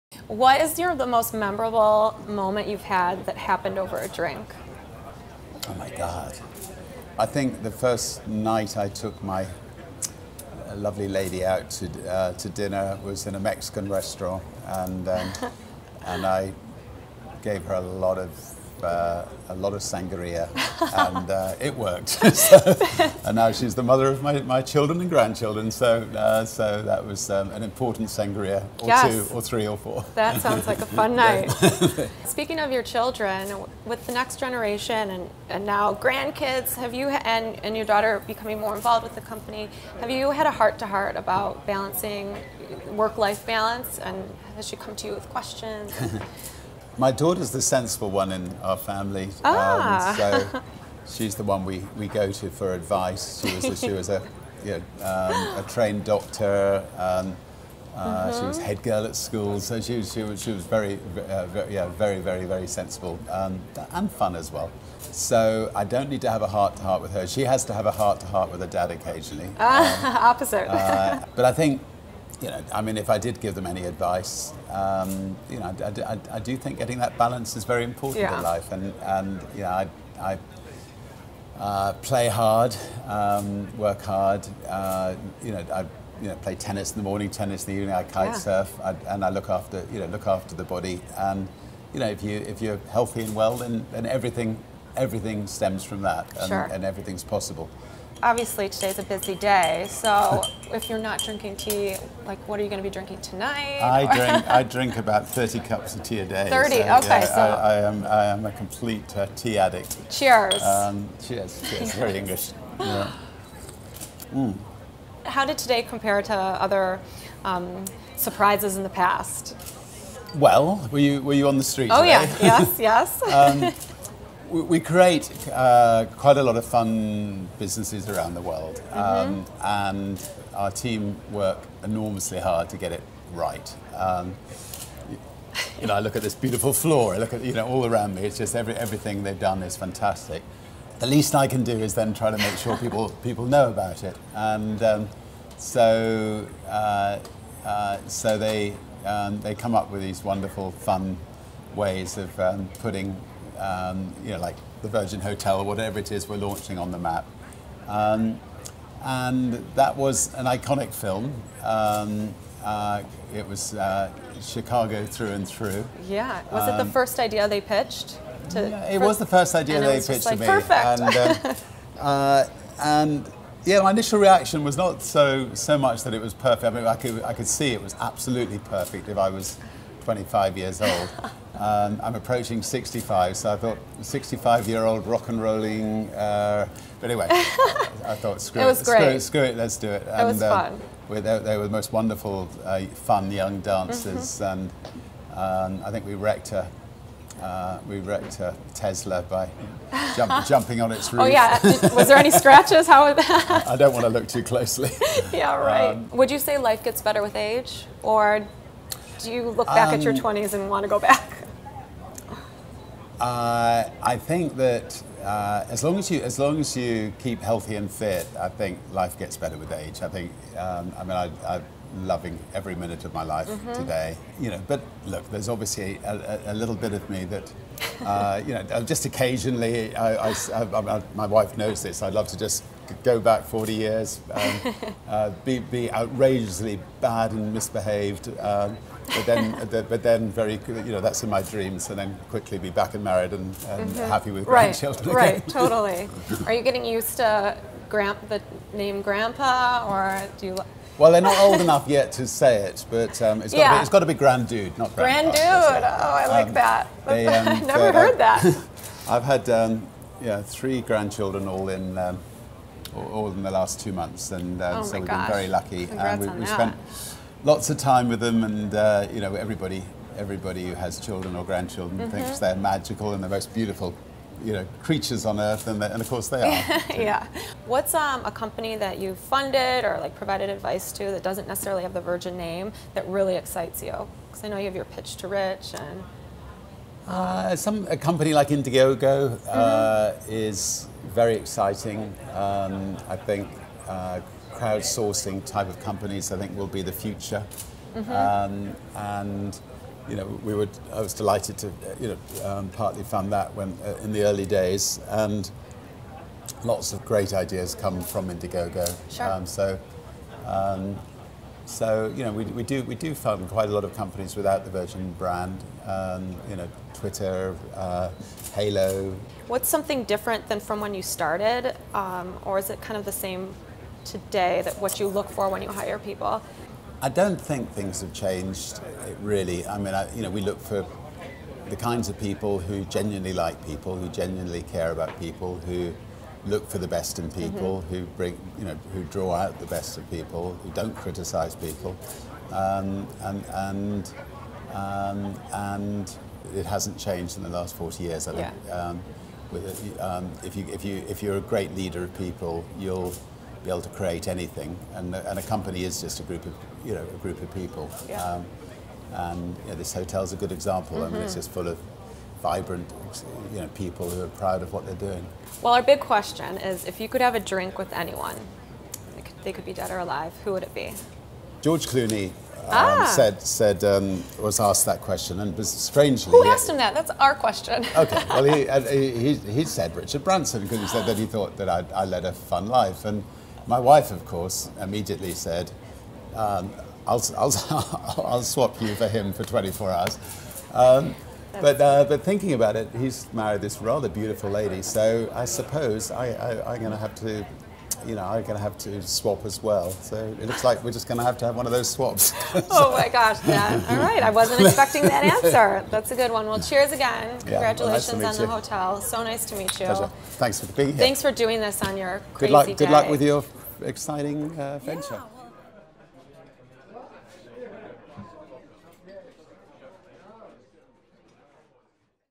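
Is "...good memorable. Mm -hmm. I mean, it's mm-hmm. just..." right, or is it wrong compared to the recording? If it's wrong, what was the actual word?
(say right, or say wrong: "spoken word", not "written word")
wrong: "example", not "memorable".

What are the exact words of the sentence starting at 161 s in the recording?
Um, uh, it was uh, Chicago through and through.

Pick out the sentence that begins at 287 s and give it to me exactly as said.
Uh, some a company like Indiegogo mm-hmm.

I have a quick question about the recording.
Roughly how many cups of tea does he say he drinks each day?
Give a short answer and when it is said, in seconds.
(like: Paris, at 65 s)
30, at 104 s.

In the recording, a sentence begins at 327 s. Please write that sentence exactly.
I don't think things have changed uh, really.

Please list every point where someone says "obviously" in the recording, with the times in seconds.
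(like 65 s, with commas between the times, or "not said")
98 s, 225 s.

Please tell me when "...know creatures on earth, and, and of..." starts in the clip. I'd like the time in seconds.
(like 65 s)
274 s.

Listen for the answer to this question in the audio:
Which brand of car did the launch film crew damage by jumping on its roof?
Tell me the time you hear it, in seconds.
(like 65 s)
198 s.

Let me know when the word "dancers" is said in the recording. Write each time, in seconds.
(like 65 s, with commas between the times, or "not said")
193 s.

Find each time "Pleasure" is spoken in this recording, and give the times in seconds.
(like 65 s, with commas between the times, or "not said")
409 s.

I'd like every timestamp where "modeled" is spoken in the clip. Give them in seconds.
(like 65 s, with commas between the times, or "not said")
not said.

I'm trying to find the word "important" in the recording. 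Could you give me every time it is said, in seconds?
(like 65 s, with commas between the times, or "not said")
27 s, 77 s.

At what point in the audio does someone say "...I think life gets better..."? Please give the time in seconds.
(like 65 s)
218 s.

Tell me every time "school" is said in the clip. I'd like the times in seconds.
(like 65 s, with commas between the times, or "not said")
59 s.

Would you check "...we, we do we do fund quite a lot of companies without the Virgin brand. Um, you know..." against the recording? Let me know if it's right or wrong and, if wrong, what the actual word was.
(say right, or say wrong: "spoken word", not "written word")
right.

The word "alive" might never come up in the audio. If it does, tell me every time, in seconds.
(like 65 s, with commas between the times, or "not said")
370 s.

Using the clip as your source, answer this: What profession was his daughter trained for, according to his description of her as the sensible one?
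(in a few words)
Doctor.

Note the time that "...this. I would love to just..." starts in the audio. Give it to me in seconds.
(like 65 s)
231 s.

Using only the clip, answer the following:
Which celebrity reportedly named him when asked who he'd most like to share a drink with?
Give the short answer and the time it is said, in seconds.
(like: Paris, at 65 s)
George Clooney, at 371 s.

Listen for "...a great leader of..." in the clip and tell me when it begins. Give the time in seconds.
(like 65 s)
351 s.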